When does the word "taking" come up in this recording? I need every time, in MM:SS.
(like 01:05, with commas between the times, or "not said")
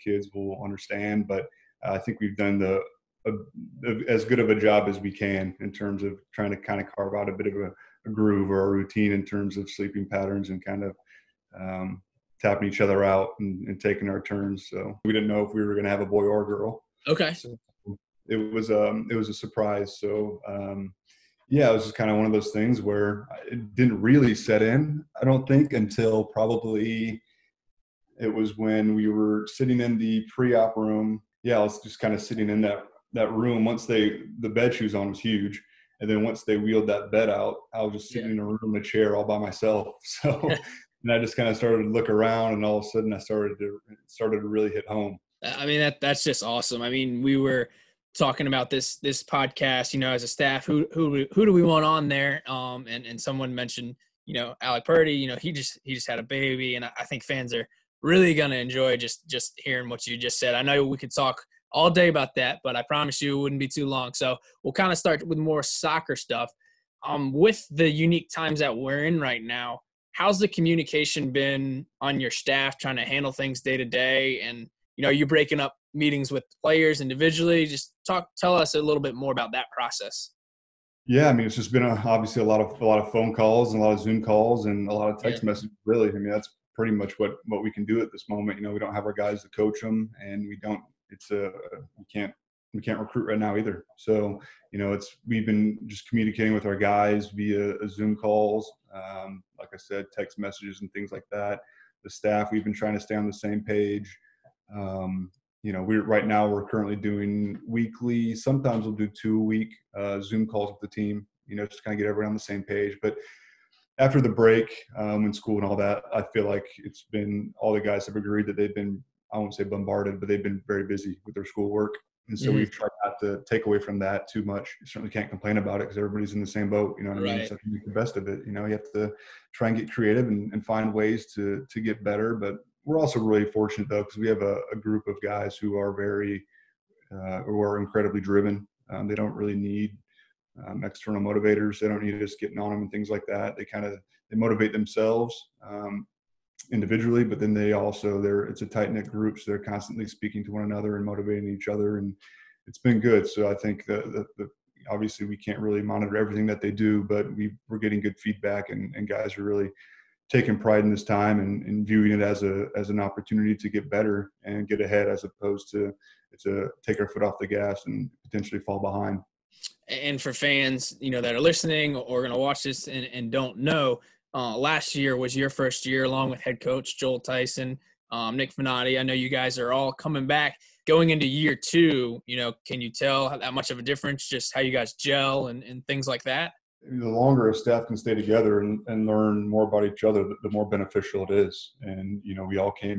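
00:13, 02:40.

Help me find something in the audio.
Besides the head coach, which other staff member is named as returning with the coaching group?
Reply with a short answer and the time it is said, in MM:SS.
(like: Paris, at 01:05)
Nick Finati, at 02:58.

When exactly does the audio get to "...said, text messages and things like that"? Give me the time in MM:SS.
01:39.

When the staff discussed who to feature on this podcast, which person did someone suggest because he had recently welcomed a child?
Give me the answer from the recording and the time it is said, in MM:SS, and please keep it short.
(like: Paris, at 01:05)
Alec Purdie, at 00:54.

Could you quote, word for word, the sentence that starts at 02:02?
we've tried not to take away from that too much.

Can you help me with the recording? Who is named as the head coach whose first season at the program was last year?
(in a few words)
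Joel Tyson.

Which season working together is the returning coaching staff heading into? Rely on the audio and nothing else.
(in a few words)
Year two.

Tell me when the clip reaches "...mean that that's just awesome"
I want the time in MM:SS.
00:45.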